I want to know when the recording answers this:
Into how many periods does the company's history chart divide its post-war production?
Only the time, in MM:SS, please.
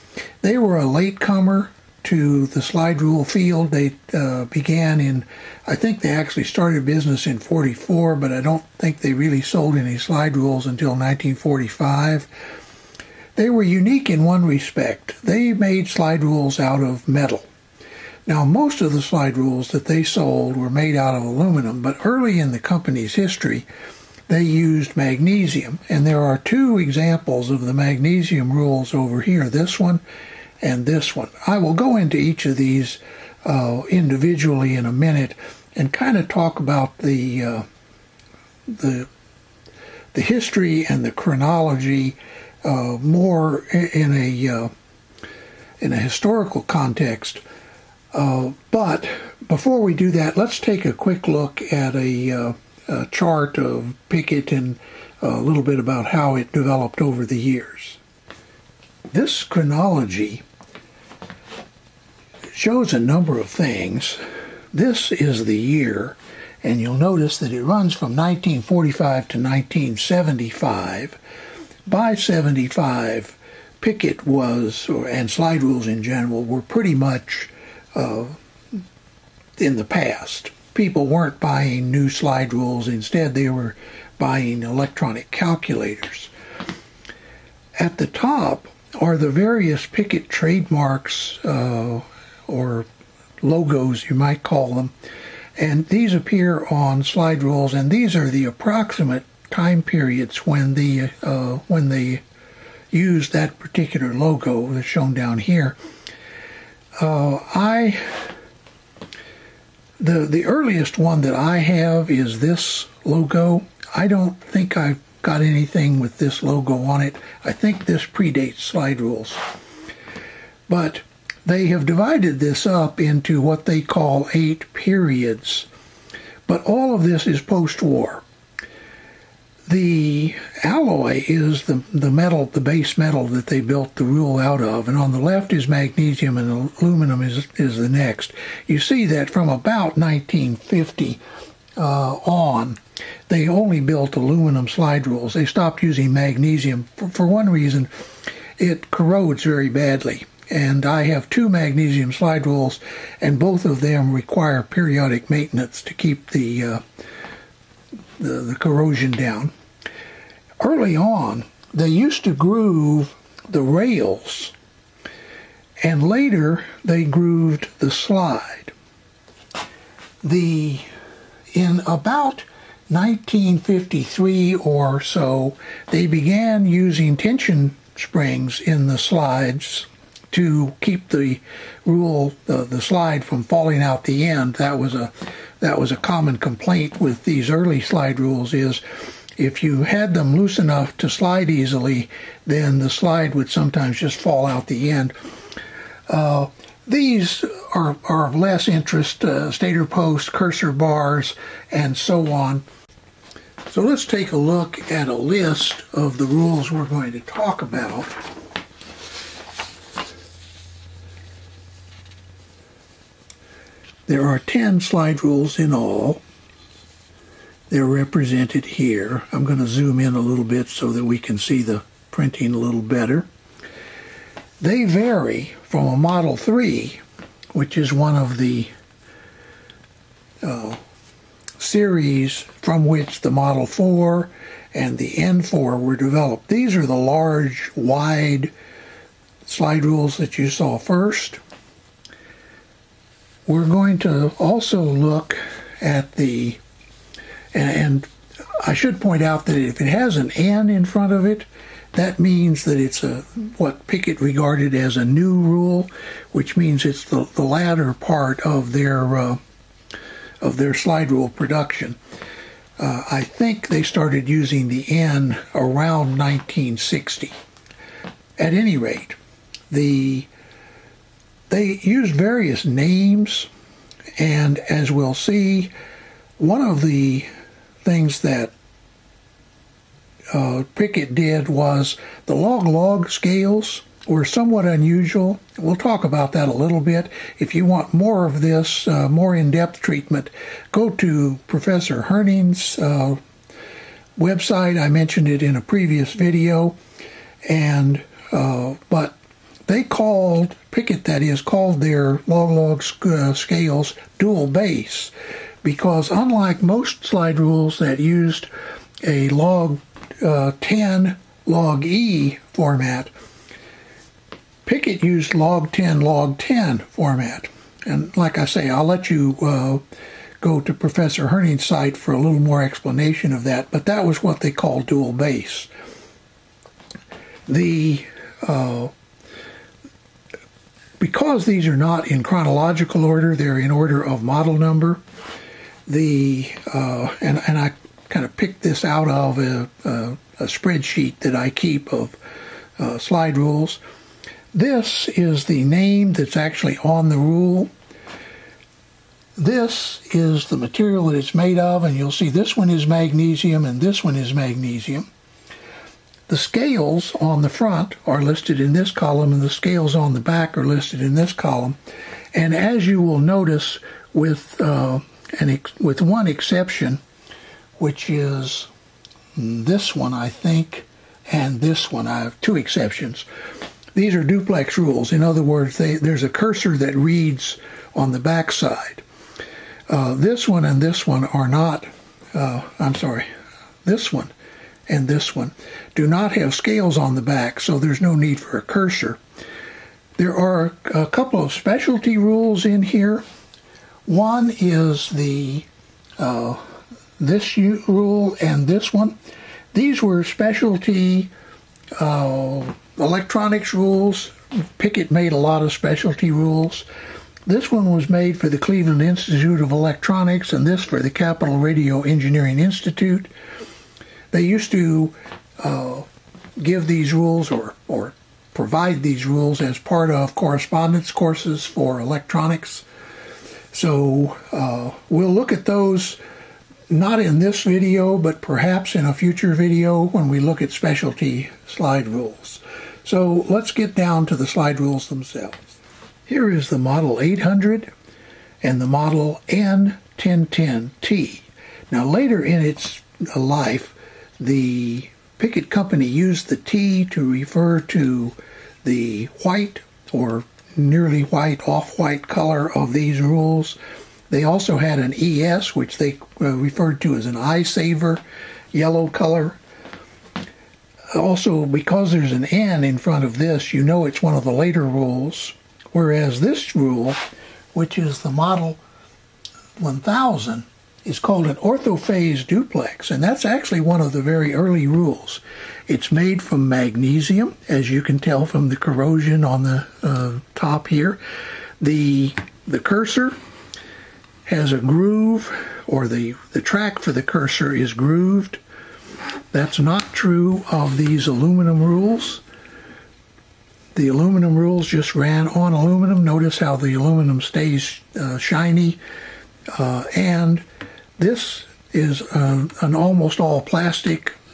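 02:04.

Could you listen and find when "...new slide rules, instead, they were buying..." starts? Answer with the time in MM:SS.
01:21.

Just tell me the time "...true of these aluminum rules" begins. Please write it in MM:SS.
08:10.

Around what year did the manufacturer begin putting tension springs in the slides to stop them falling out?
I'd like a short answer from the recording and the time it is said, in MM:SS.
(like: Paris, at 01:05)
1953, at 02:52.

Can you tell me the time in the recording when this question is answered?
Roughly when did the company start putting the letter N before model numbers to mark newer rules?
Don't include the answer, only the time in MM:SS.
04:25.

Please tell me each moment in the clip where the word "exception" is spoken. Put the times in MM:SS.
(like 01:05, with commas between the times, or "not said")
06:06, 06:12.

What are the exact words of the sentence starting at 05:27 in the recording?
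The uh, because these are not in chronological order, they're in order of model number.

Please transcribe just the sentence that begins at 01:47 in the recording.
Uh, I the the earliest one that I have is this logo.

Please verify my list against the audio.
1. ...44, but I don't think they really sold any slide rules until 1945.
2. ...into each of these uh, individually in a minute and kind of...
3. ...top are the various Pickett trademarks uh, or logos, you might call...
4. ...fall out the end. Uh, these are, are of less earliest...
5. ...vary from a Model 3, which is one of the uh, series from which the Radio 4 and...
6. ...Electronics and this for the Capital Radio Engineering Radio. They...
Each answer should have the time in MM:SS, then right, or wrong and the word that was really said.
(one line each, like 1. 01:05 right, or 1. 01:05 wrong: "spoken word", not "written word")
1. 00:07 right
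2. 00:31 right
3. 01:28 right
4. 03:14 wrong: "interest", not "earliest"
5. 03:44 wrong: "Model", not "Radio"
6. 06:49 wrong: "Institute", not "Radio".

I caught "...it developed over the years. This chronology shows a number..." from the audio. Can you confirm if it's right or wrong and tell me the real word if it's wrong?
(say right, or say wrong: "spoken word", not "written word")
right.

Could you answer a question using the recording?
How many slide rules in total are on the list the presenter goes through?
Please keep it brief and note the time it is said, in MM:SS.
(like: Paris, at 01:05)
10, at 03:34.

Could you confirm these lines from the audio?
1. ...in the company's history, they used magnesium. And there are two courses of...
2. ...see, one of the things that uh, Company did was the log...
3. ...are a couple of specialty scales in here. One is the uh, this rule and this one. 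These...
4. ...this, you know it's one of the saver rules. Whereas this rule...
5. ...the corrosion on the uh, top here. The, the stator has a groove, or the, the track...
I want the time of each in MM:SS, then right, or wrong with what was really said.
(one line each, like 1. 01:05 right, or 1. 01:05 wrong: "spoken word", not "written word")
1. 00:22 wrong: "examples", not "courses"
2. 04:35 wrong: "Pickett", not "Company"
3. 06:30 wrong: "rules", not "scales"
4. 07:43 wrong: "later", not "saver"
5. 07:58 wrong: "cursor", not "stator".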